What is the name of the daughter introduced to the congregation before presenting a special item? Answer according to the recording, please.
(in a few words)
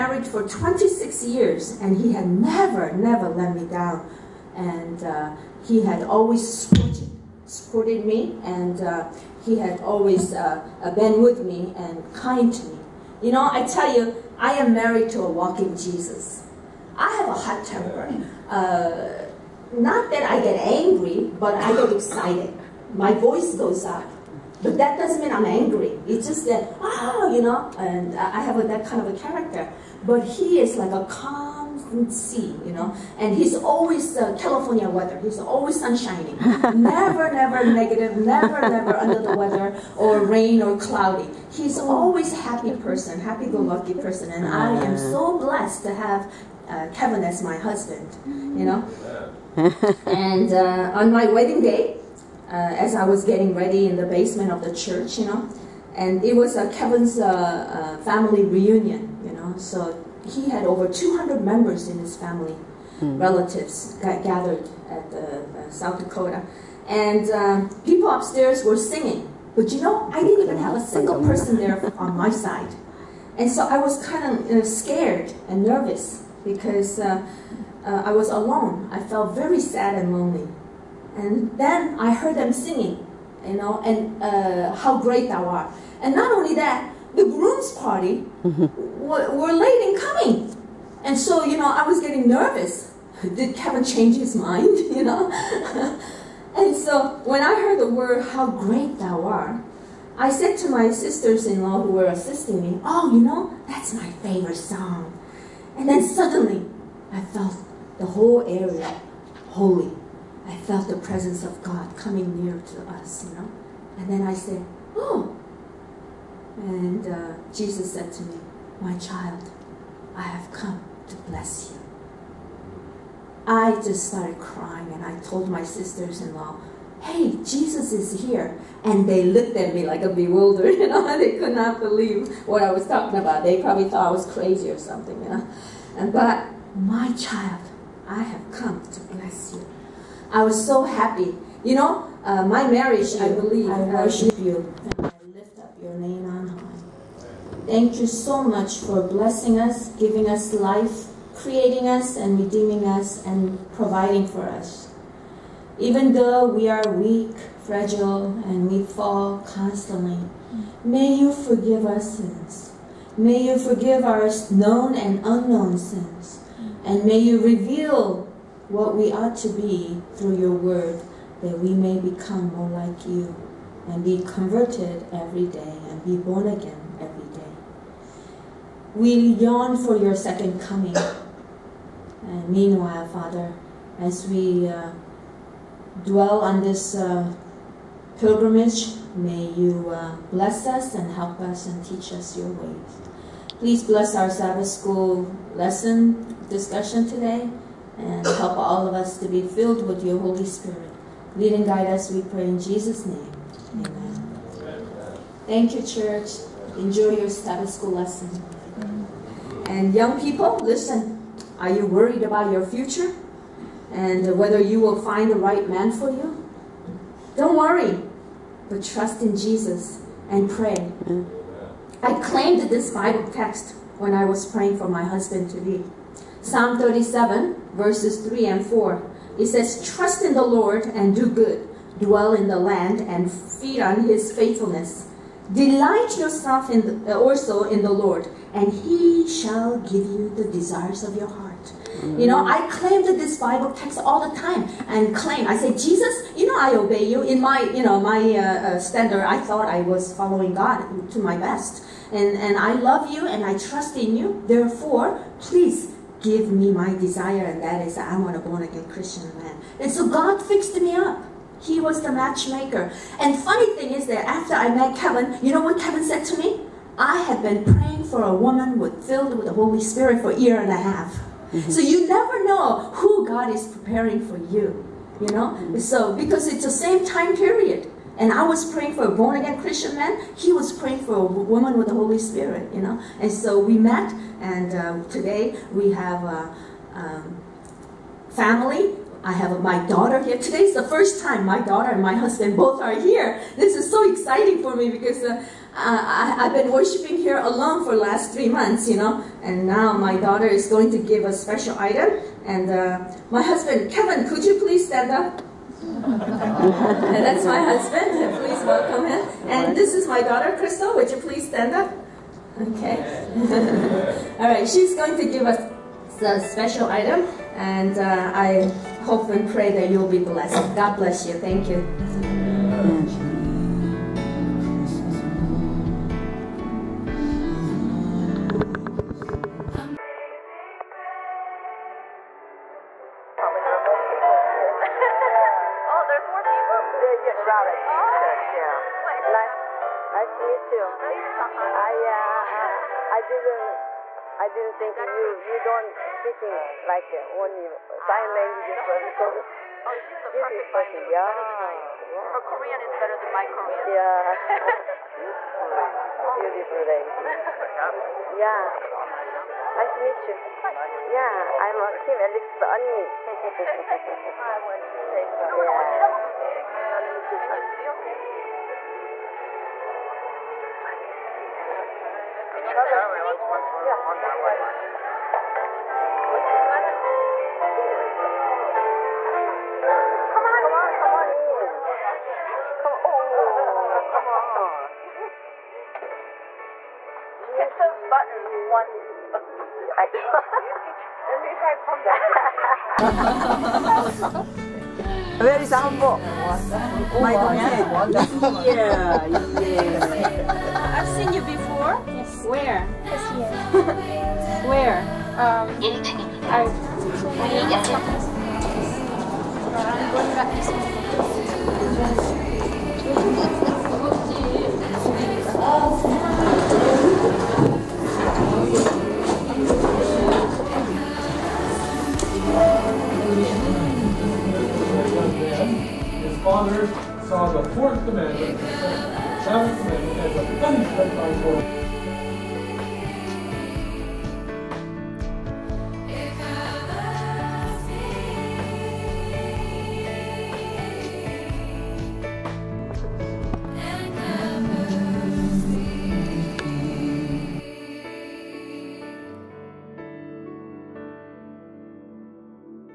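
Crystal.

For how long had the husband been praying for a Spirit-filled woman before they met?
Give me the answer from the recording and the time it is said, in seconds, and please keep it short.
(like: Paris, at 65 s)
A year and a half, at 270 s.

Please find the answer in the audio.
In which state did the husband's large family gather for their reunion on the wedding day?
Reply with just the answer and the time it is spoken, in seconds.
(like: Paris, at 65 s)
South Dakota, at 65 s.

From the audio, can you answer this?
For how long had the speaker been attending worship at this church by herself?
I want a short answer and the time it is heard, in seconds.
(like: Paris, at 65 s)
Three months, at 298 s.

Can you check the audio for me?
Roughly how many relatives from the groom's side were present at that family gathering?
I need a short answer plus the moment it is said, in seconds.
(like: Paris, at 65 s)
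Over 200, at 60 s.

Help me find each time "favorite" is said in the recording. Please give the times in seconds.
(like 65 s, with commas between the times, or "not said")
104 s.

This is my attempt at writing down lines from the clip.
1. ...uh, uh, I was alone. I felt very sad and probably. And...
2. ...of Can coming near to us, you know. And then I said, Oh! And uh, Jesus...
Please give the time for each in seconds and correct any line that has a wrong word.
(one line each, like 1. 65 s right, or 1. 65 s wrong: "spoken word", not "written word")
1. 76 s wrong: "lonely", not "probably"
2. 111 s wrong: "God", not "Can".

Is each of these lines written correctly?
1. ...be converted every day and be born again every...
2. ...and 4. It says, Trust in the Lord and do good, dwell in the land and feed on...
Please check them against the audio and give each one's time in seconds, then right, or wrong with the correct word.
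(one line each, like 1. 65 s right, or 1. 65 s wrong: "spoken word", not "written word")
1. 174 s right
2. 228 s right.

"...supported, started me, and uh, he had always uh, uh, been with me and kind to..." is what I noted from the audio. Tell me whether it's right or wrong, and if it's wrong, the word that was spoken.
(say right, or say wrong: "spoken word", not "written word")
wrong: "supported", not "started".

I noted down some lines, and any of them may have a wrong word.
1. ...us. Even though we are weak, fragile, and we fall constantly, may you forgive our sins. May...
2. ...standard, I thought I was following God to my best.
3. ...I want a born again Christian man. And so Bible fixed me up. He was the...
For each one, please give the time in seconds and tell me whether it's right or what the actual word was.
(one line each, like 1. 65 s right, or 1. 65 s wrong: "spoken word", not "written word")
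1. 154 s right
2. 248 s right
3. 257 s wrong: "God", not "Bible".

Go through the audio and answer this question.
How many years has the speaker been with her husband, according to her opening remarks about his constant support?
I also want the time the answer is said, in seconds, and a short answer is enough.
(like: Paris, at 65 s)
26, at 0 s.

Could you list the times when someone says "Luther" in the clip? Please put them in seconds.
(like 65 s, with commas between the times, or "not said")
not said.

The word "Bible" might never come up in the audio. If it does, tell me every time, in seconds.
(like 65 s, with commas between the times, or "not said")
222 s, 243 s.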